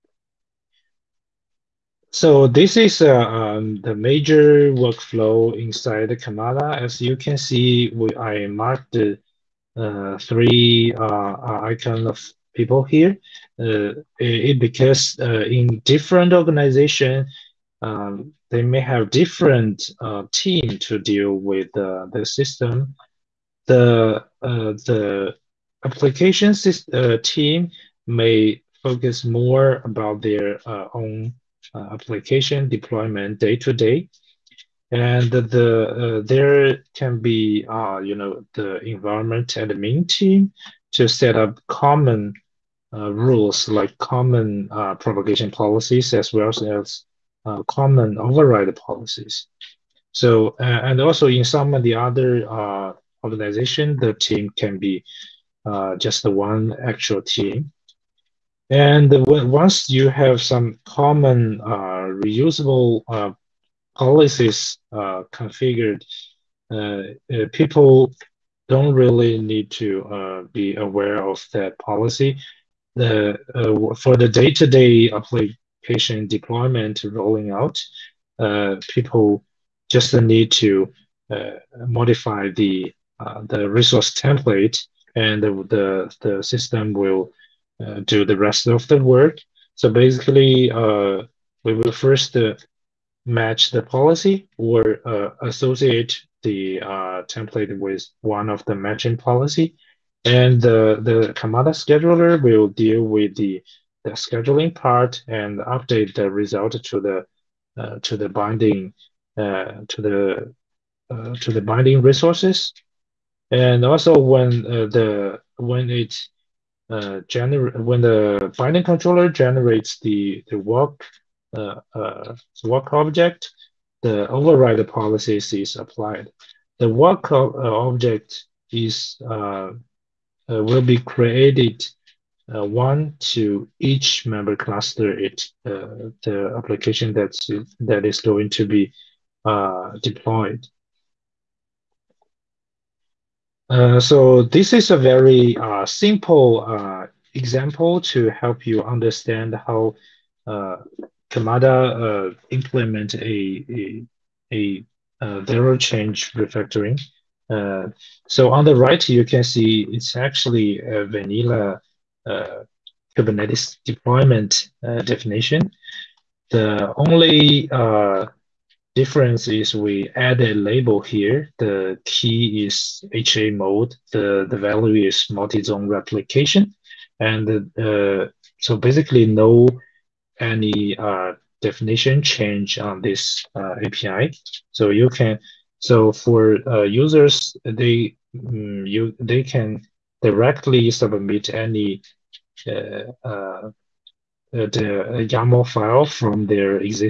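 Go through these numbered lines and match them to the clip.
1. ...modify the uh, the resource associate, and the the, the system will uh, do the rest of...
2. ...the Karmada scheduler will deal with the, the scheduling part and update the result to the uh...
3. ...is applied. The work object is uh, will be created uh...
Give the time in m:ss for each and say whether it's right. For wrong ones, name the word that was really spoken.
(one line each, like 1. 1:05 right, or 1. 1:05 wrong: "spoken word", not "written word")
1. 1:21 wrong: "template", not "associate"
2. 1:41 right
3. 2:05 right.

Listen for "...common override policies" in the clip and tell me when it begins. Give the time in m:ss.
0:47.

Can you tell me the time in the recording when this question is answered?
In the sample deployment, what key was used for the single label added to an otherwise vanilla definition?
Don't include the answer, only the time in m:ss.
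2:53.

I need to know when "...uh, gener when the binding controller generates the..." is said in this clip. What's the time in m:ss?
1:56.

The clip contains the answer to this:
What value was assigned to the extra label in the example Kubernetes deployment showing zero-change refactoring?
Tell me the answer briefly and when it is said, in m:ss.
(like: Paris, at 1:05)
multi-zone replication, at 2:55.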